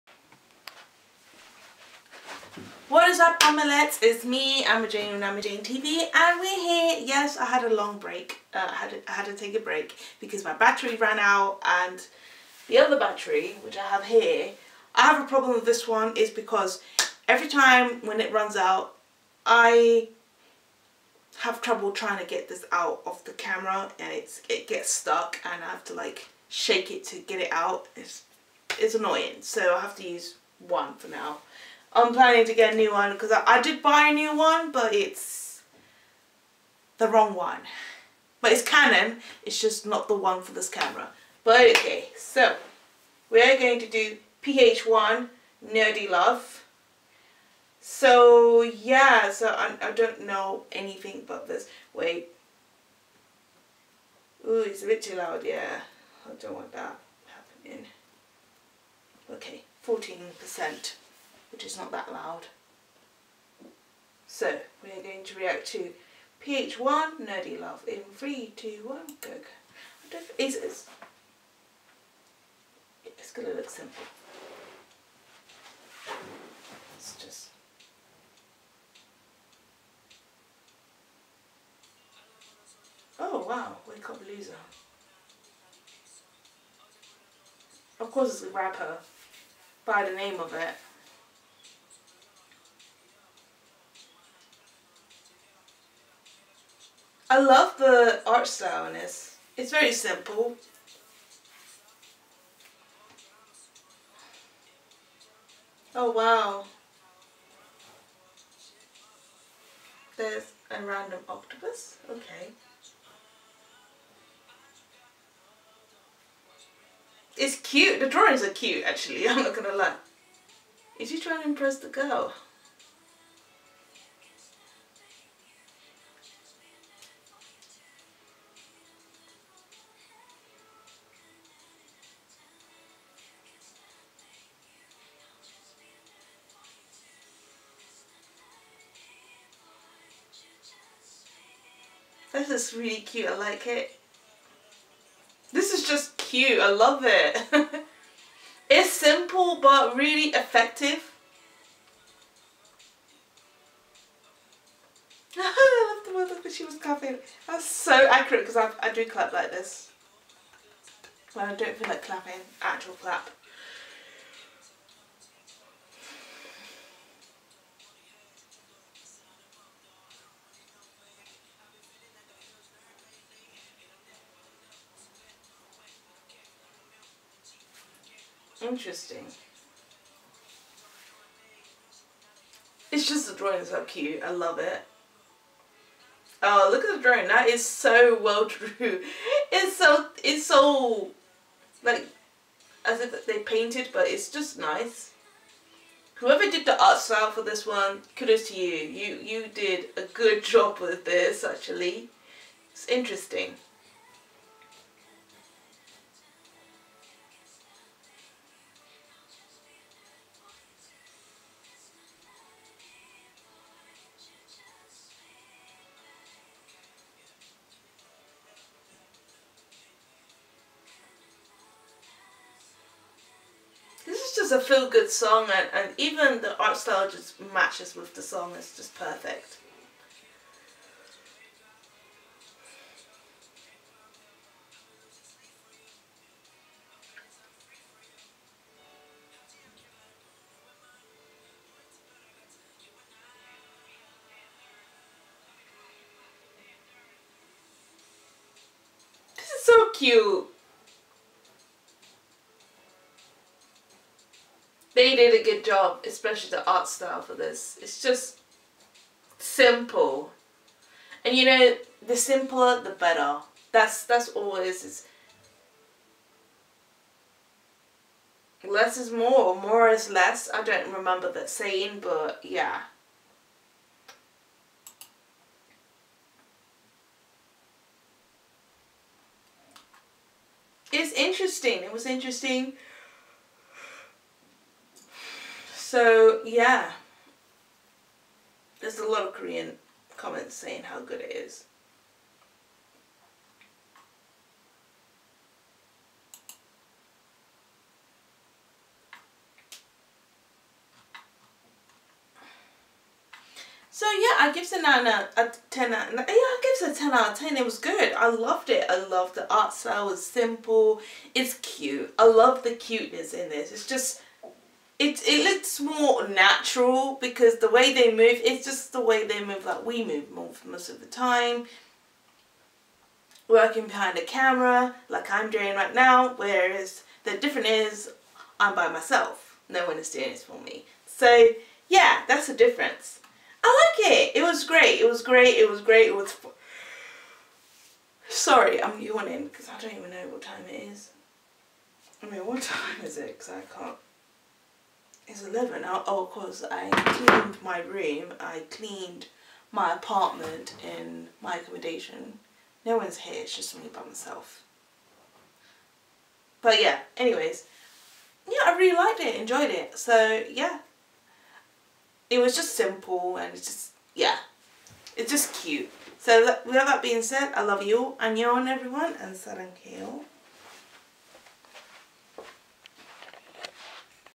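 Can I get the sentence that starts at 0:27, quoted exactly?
It's, it's annoying so I have to use one for now.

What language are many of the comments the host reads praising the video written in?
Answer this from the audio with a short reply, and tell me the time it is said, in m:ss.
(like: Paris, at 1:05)
Korean, at 4:49.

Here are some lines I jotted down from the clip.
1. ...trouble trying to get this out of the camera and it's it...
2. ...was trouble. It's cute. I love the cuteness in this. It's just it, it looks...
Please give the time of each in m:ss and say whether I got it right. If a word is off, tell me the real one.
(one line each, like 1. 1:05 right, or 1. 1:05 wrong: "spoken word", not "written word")
1. 0:21 right
2. 5:10 wrong: "simple", not "trouble".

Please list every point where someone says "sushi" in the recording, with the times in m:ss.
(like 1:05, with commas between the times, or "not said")
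not said.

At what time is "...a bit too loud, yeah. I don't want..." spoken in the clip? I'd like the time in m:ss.
0:54.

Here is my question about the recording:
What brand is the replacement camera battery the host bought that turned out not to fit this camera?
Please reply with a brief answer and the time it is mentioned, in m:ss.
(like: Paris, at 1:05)
Canon, at 0:38.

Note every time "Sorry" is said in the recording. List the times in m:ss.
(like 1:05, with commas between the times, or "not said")
5:38.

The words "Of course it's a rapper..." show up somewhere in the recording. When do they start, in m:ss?
1:27.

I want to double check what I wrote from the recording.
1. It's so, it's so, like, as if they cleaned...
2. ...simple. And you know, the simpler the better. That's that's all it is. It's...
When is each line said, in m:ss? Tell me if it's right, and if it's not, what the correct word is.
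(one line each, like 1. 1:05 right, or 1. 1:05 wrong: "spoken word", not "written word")
1. 3:09 wrong: "painted", not "cleaned"
2. 4:19 right.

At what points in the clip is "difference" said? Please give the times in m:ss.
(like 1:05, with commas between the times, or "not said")
5:27, 5:32.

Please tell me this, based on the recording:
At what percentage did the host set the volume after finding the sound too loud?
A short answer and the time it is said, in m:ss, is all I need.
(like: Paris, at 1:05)
14%, at 0:59.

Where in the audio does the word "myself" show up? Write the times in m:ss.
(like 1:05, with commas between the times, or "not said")
5:28, 5:54.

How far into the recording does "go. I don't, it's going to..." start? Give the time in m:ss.
1:09.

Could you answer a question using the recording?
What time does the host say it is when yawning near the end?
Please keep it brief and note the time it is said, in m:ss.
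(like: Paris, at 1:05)
11, at 5:45.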